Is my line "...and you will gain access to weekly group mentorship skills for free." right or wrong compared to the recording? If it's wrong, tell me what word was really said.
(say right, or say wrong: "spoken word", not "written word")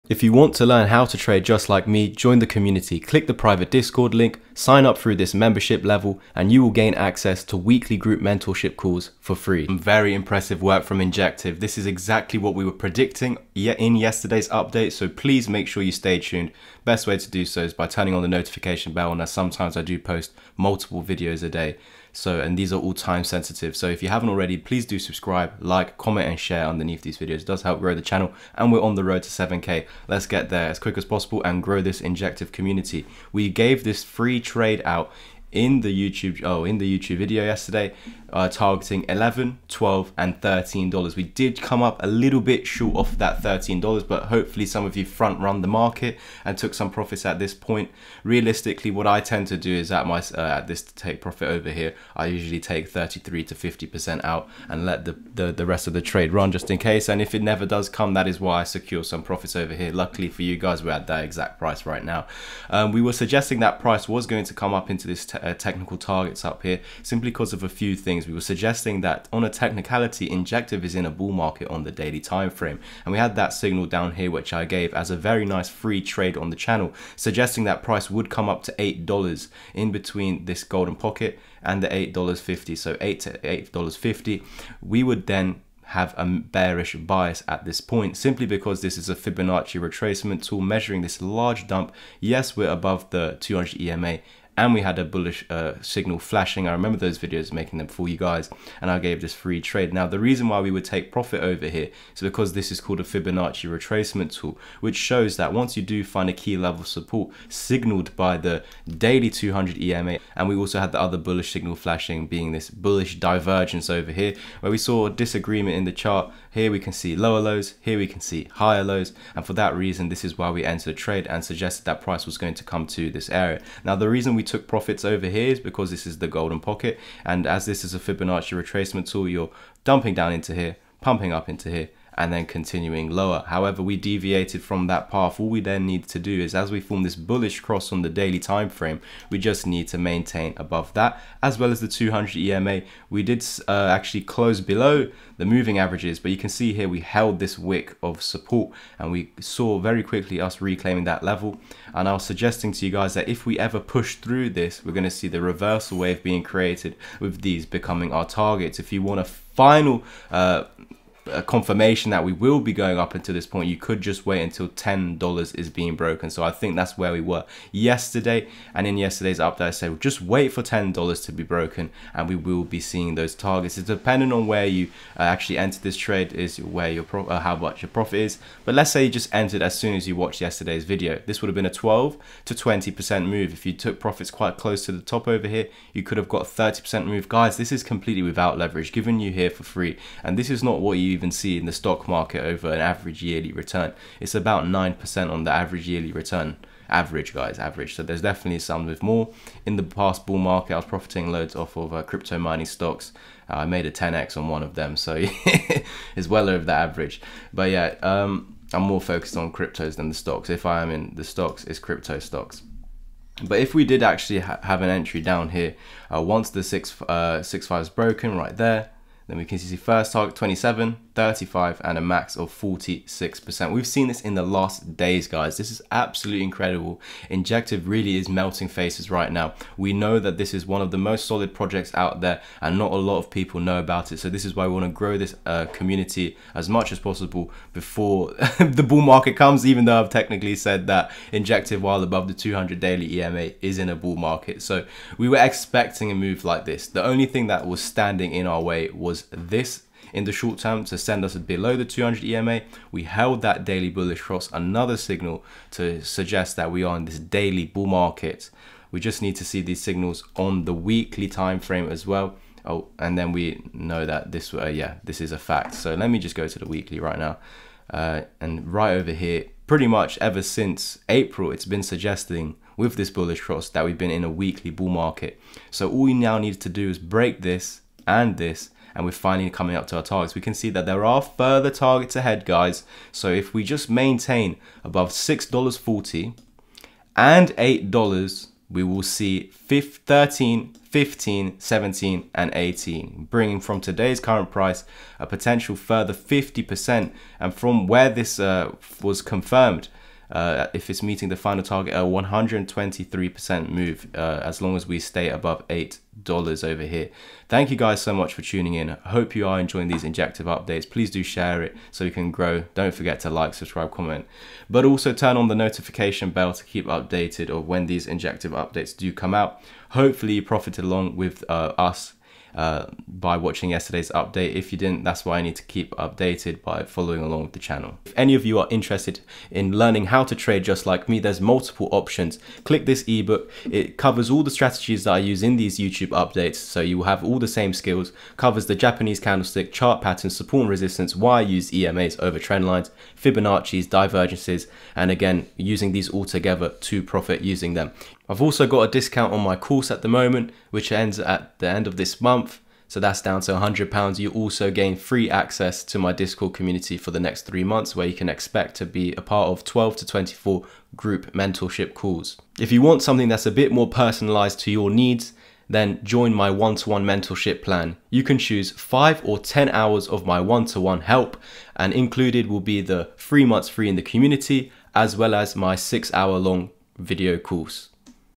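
wrong: "calls", not "skills".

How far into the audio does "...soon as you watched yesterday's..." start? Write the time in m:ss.
2:59.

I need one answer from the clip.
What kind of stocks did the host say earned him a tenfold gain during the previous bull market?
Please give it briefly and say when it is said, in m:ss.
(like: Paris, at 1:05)
crypto mining stocks, at 3:22.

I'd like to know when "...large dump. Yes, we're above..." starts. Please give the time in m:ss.
1:31.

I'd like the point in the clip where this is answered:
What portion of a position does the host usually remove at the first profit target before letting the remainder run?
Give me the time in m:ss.
0:52.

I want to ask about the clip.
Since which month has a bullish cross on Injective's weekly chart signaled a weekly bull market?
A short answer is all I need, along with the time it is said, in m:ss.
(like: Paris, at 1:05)
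April, at 4:31.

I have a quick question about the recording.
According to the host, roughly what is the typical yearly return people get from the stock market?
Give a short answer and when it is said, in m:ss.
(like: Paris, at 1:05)
9%, at 3:14.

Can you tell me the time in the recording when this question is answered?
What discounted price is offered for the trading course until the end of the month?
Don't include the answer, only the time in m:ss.
5:53.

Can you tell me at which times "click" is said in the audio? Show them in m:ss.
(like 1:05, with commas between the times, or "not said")
0:02, 5:32.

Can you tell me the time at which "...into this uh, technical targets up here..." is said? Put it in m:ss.
1:04.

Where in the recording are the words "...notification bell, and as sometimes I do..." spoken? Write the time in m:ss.
0:18.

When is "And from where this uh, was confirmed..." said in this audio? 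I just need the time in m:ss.
4:57.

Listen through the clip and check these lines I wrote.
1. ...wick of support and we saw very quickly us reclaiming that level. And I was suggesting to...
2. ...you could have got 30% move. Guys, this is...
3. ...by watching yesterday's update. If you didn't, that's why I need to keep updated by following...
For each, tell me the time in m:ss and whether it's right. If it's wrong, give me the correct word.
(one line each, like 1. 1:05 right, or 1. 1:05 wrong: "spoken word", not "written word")
1. 2:27 right
2. 3:05 right
3. 5:23 right.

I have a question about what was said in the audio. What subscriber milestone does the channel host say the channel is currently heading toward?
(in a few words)
7K.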